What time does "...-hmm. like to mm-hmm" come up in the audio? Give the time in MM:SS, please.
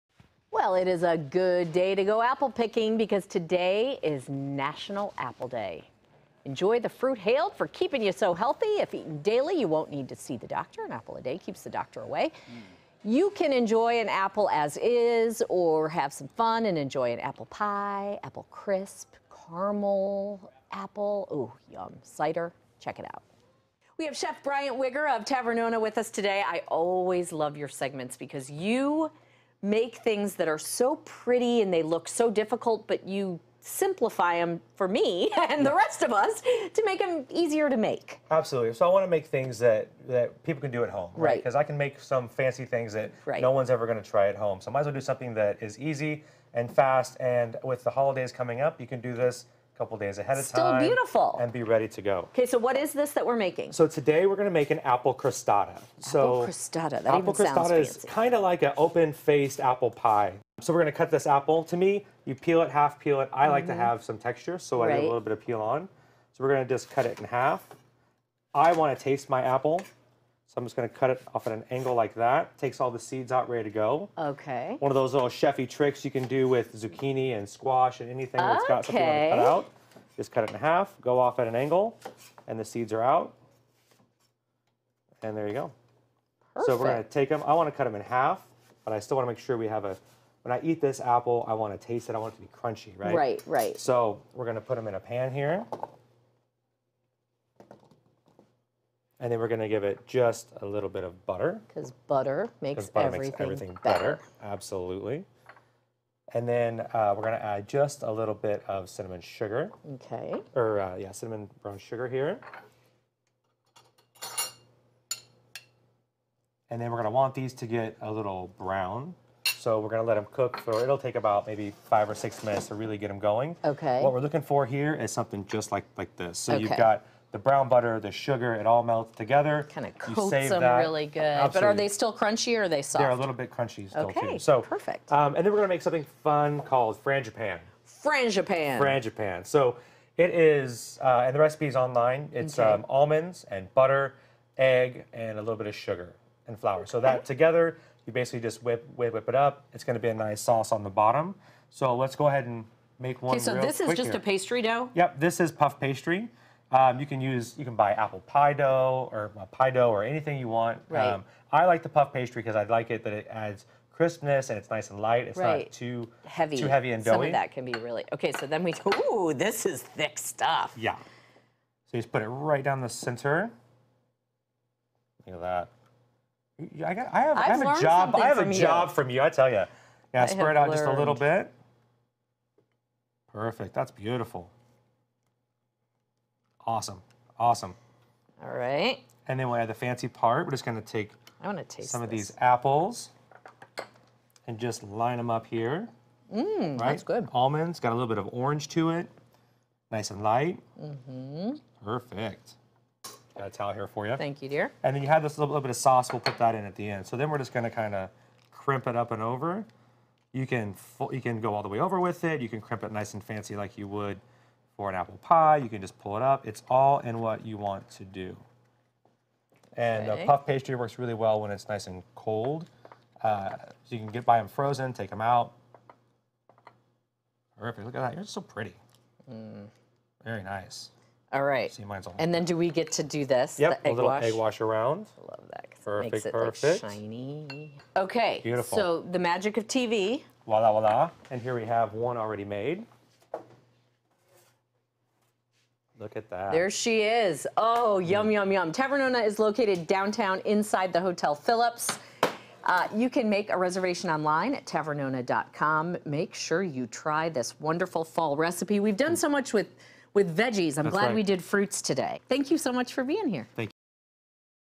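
01:03.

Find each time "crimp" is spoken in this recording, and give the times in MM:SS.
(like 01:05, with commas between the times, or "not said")
03:28, 03:32.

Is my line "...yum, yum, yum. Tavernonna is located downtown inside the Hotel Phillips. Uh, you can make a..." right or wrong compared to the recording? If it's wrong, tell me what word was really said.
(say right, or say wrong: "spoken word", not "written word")
right.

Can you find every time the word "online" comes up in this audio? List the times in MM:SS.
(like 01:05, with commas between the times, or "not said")
02:21, 04:14.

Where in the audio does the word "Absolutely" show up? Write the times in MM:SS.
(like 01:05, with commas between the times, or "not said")
00:38, 01:44, 02:11.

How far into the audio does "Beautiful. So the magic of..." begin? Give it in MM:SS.
03:58.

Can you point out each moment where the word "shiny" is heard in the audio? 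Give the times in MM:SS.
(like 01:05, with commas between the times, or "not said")
03:56.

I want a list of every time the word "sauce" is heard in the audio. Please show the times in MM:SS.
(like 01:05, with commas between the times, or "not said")
02:30, 03:25.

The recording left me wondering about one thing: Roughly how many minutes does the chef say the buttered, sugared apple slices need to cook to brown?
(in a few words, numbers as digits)
5 or 6 minutes.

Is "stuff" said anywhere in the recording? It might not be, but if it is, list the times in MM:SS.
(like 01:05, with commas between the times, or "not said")
02:50.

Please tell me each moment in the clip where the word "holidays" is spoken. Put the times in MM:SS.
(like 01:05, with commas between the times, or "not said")
00:47.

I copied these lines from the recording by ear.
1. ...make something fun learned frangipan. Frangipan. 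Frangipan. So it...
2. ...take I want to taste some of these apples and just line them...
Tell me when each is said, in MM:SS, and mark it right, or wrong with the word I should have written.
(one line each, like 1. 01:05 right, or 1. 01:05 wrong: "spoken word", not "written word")
1. 02:15 wrong: "called", not "learned"
2. 03:10 right.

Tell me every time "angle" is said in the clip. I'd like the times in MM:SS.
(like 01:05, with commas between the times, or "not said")
01:11, 01:21.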